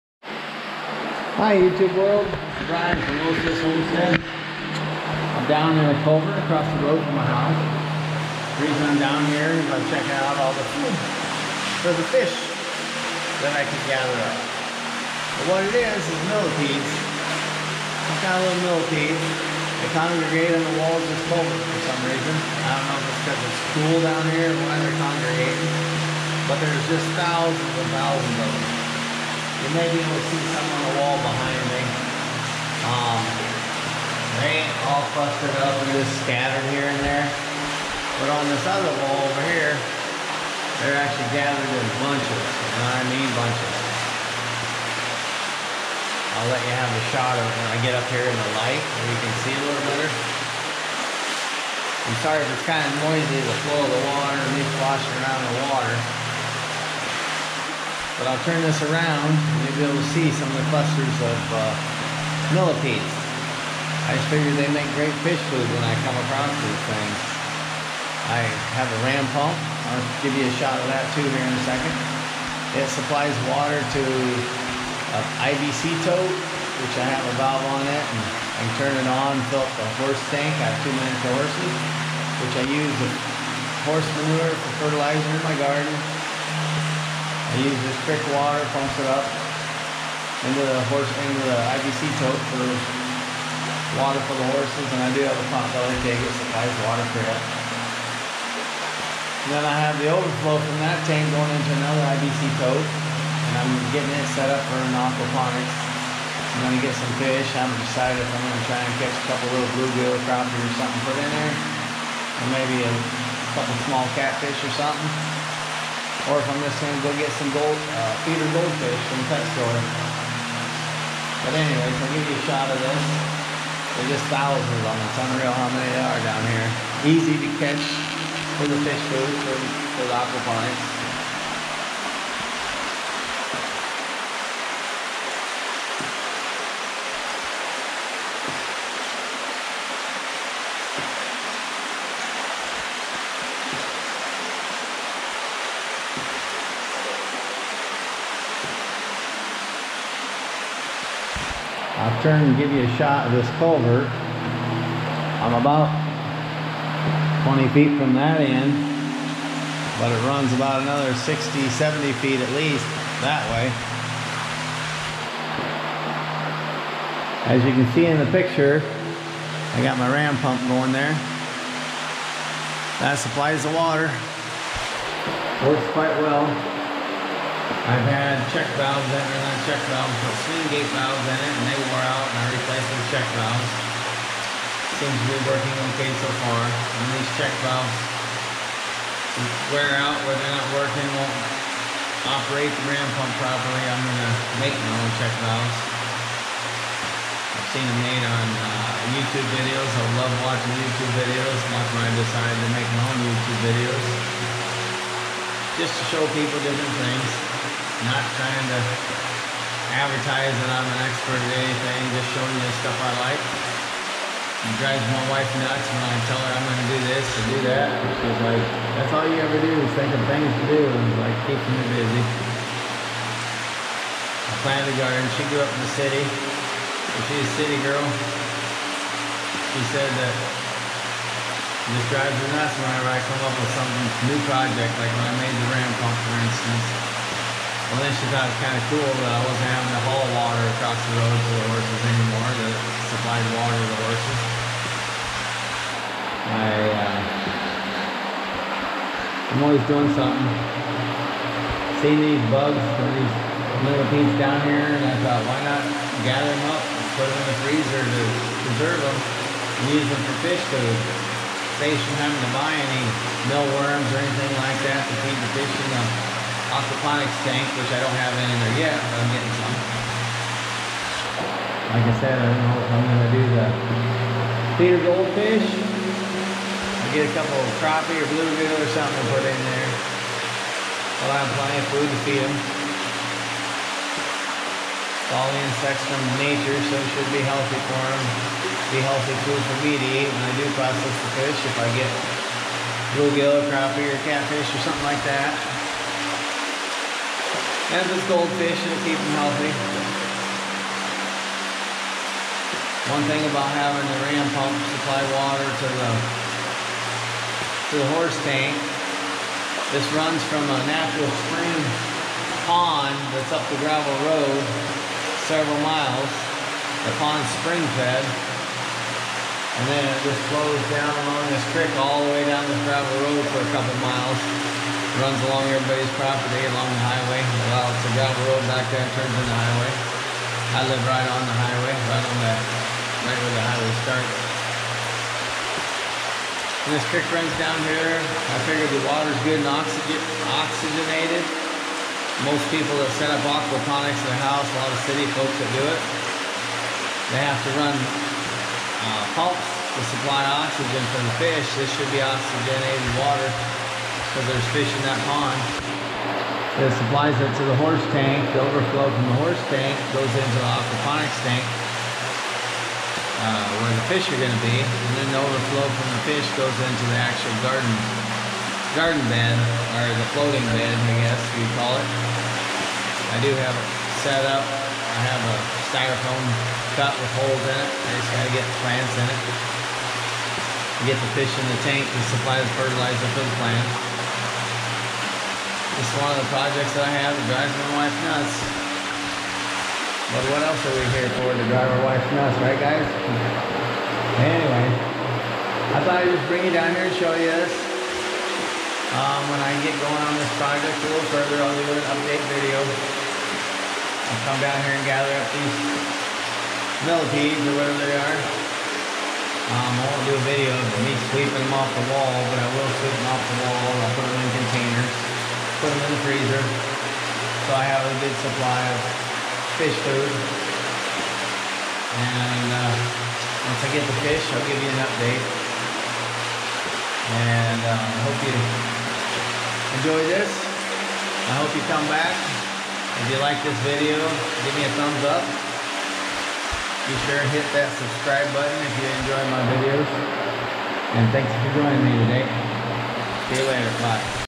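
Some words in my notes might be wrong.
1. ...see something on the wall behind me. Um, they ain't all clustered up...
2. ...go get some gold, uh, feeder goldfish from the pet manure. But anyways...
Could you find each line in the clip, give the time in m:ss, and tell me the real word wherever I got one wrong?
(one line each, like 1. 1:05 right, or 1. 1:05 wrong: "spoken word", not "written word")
1. 0:30 right
2. 1:57 wrong: "store", not "manure".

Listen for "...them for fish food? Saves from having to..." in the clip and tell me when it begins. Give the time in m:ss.
4:20.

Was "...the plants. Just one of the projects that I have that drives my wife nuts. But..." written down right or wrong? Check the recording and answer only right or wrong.
right.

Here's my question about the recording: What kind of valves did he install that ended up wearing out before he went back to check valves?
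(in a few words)
Swing gate valves.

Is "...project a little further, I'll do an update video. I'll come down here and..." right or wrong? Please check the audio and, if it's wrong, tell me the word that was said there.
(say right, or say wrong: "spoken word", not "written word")
right.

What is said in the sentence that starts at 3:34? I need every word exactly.
It drives my wife nuts when I tell her I'm going to do this or do that.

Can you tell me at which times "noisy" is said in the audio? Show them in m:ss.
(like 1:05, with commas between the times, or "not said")
0:53.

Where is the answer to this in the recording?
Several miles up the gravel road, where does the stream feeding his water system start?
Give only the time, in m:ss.
5:10.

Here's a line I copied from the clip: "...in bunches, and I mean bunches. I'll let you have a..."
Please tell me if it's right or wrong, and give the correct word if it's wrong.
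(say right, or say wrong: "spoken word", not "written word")
right.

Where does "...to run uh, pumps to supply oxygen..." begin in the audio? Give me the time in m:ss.
5:47.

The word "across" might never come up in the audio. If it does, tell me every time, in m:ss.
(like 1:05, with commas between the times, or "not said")
0:06, 1:06, 4:00.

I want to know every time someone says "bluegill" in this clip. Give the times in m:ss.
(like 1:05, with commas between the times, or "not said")
1:49, 4:38, 4:53.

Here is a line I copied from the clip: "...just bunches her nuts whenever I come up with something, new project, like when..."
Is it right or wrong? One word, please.
wrong.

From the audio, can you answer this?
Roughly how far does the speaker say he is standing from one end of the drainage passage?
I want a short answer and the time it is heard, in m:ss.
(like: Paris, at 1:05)
20 feet, at 2:37.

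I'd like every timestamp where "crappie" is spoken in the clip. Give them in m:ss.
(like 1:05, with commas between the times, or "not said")
1:50, 4:37, 4:53.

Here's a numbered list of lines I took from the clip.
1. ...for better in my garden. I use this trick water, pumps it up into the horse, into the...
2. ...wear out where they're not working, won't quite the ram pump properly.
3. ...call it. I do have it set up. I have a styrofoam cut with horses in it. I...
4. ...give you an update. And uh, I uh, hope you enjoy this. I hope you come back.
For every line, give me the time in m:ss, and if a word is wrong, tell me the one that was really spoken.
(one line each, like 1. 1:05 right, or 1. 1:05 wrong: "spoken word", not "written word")
1. 1:24 wrong: "fertilizer", not "better"
2. 3:09 wrong: "operate", not "quite"
3. 6:11 wrong: "holes", not "horses"
4. 7:04 right.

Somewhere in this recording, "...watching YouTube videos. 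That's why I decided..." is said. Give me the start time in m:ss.
3:20.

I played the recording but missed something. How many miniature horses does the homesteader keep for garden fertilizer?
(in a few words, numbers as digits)
2.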